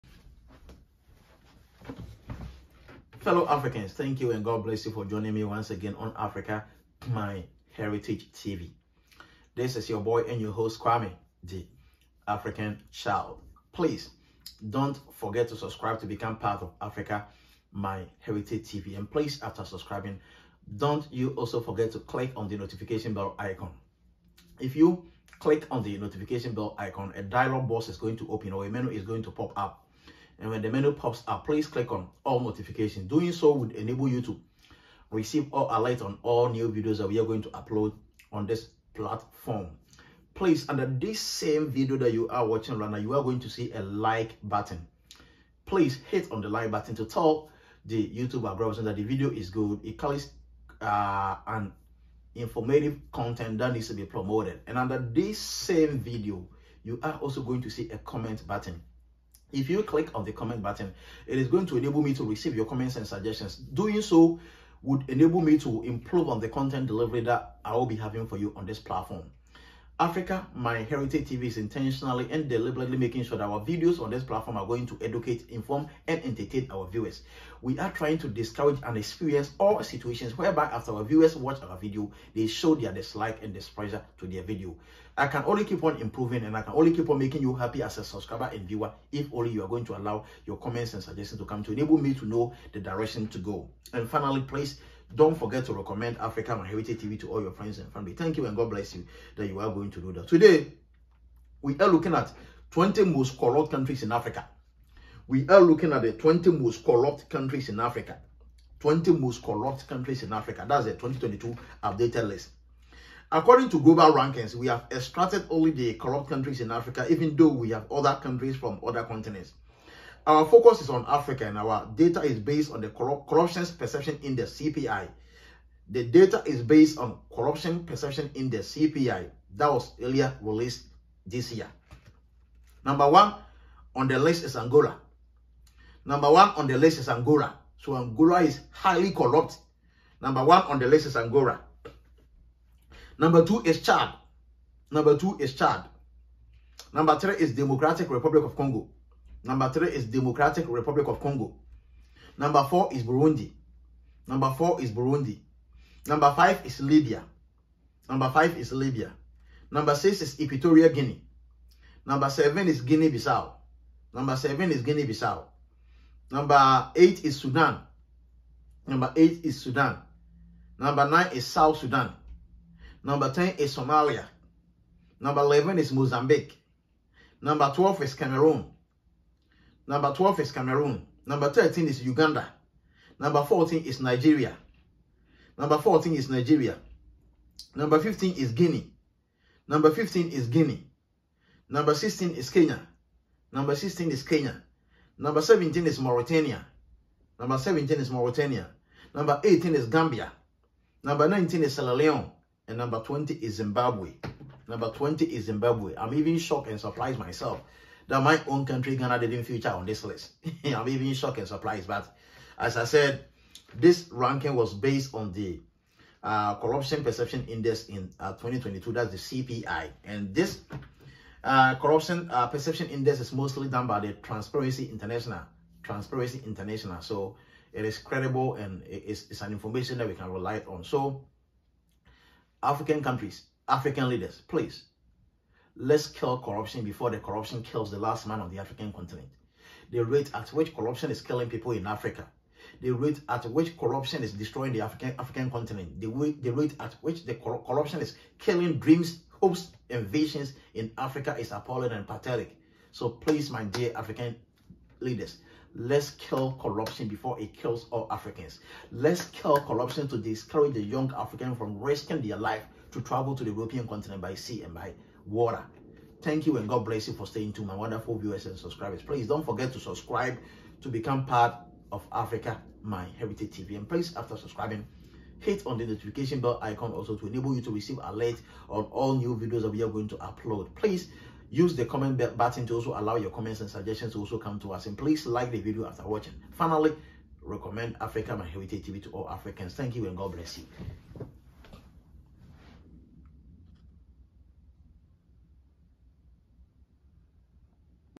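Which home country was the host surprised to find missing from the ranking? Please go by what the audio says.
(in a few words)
Ghana.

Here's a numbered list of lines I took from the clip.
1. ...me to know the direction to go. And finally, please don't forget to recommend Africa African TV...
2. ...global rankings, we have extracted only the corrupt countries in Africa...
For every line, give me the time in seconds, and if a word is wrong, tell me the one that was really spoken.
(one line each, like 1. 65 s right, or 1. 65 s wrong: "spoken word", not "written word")
1. 91 s wrong: "Heritage", not "African"
2. 113 s right.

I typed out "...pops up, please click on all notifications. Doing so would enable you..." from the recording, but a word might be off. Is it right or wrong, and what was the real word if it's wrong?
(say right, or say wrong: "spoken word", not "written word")
right.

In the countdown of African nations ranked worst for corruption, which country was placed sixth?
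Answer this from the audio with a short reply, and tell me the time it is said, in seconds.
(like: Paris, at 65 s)
Equatorial Guinea, at 160 s.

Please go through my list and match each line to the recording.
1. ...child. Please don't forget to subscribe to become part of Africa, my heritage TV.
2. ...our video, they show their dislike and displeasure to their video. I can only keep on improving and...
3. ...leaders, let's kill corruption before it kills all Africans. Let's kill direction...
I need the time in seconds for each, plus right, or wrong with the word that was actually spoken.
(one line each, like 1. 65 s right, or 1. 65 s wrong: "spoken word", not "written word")
1. 12 s right
2. 81 s right
3. 254 s wrong: "corruption", not "direction".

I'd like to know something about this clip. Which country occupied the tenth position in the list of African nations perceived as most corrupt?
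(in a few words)
Somalia.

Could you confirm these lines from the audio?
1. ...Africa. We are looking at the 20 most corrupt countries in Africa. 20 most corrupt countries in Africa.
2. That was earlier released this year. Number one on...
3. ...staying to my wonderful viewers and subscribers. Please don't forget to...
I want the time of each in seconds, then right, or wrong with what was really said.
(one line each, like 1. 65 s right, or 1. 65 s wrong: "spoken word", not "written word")
1. 104 s right
2. 129 s right
3. 267 s right.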